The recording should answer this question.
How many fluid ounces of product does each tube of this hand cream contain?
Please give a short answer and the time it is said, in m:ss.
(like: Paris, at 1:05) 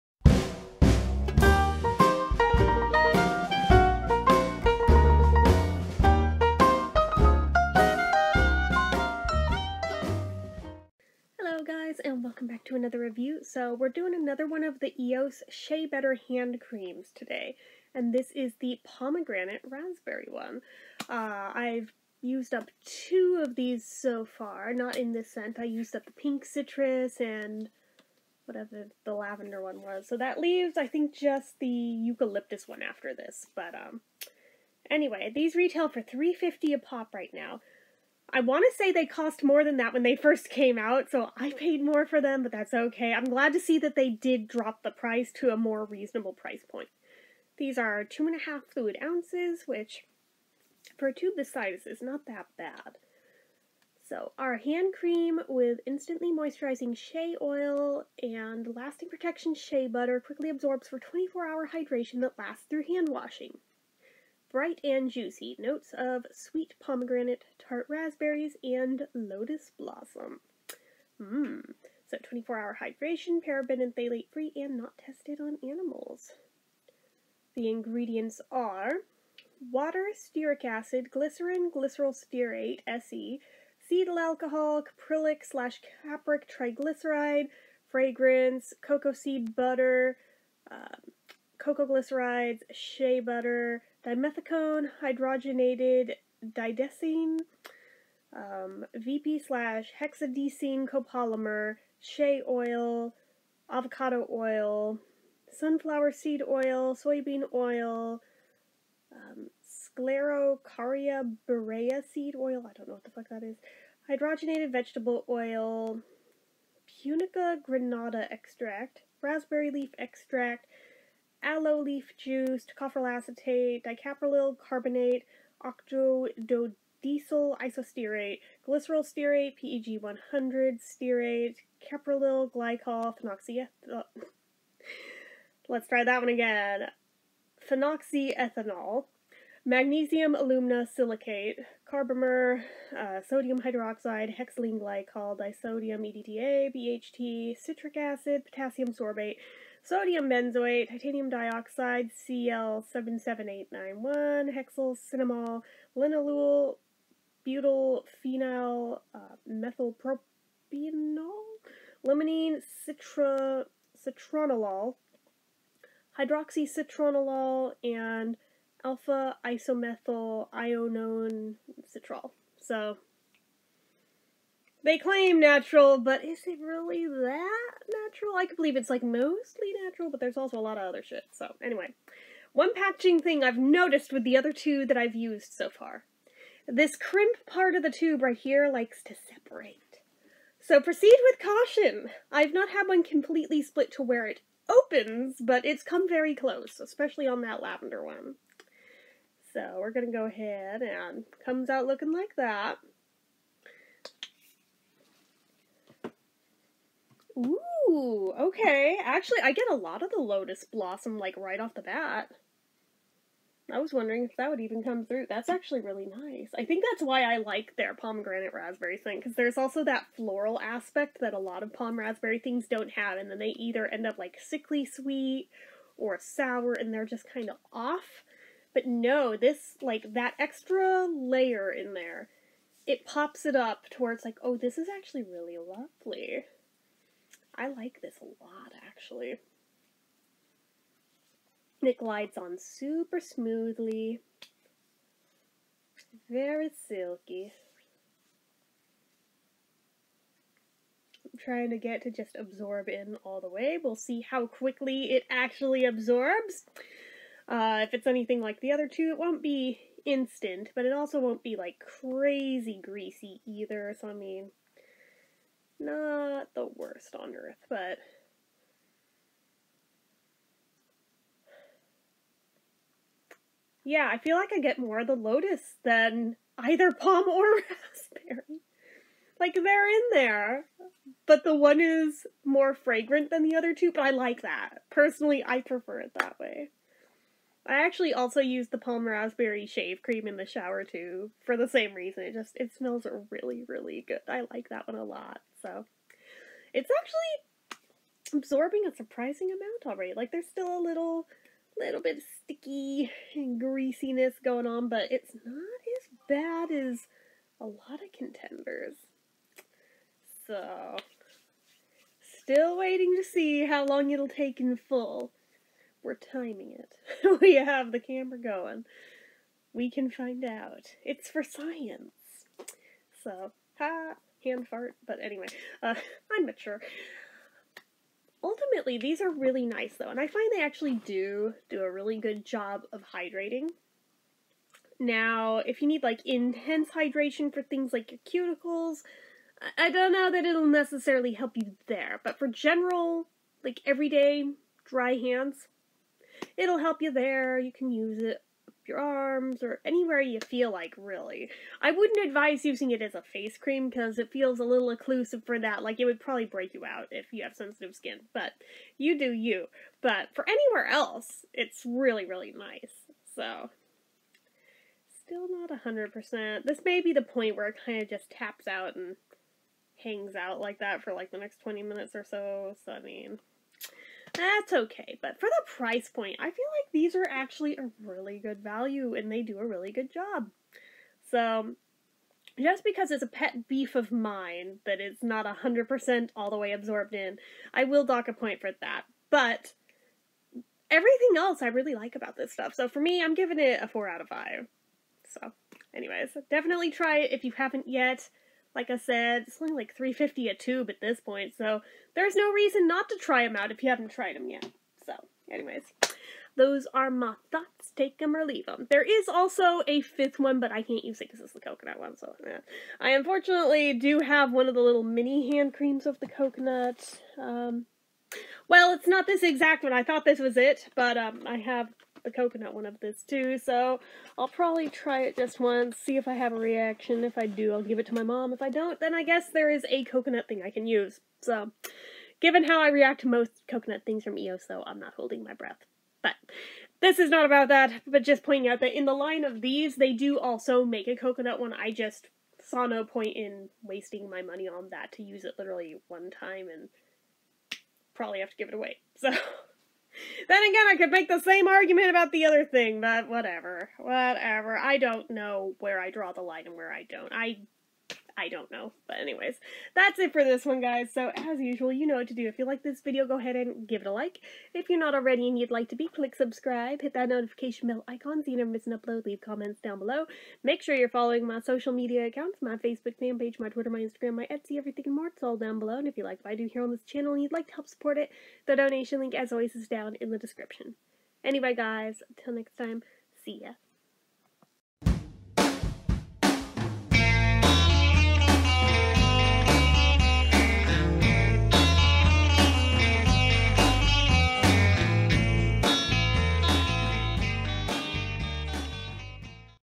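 2.5, at 0:48.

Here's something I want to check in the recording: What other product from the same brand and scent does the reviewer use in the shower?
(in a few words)
shave cream.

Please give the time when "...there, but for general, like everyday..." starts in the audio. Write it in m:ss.
5:41.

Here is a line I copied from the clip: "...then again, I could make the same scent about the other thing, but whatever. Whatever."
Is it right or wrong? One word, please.
wrong.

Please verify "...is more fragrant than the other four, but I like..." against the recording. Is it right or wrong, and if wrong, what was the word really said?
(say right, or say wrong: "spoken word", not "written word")
wrong: "two", not "four".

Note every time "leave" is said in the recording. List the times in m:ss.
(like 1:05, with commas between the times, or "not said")
0:30, 6:48, 7:49.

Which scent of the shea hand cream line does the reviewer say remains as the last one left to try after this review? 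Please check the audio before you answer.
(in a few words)
eucalyptus.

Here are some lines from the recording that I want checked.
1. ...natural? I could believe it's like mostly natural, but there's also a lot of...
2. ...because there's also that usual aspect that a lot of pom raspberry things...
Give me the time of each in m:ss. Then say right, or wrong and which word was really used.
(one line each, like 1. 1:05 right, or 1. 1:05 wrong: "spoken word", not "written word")
1. 2:58 right
2. 3:39 wrong: "floral", not "usual".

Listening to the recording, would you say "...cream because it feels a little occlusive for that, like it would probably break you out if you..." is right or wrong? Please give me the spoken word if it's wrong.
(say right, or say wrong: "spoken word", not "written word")
right.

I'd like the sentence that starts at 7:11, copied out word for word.
So, given how I react to most coconut things from EOS, though, I'm not holding my breath.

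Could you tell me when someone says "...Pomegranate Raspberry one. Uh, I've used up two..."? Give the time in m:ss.
0:18.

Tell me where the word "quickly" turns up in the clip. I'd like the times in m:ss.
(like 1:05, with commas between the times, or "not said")
1:00, 4:14.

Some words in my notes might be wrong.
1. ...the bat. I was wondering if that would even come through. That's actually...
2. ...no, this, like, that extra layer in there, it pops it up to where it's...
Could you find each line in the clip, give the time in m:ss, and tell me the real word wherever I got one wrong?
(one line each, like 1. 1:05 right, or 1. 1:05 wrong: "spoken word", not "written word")
1. 3:31 right
2. 3:48 right.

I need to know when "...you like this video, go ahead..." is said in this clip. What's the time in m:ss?
7:42.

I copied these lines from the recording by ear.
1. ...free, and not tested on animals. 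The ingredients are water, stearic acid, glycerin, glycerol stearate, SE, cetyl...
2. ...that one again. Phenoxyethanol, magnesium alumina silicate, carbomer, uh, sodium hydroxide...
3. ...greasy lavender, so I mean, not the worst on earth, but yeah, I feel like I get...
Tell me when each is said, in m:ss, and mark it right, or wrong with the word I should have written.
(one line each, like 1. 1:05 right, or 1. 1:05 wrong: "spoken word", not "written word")
1. 1:14 right
2. 2:16 right
3. 4:22 wrong: "either", not "lavender".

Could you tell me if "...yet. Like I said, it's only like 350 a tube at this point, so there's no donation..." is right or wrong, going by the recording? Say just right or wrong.
wrong.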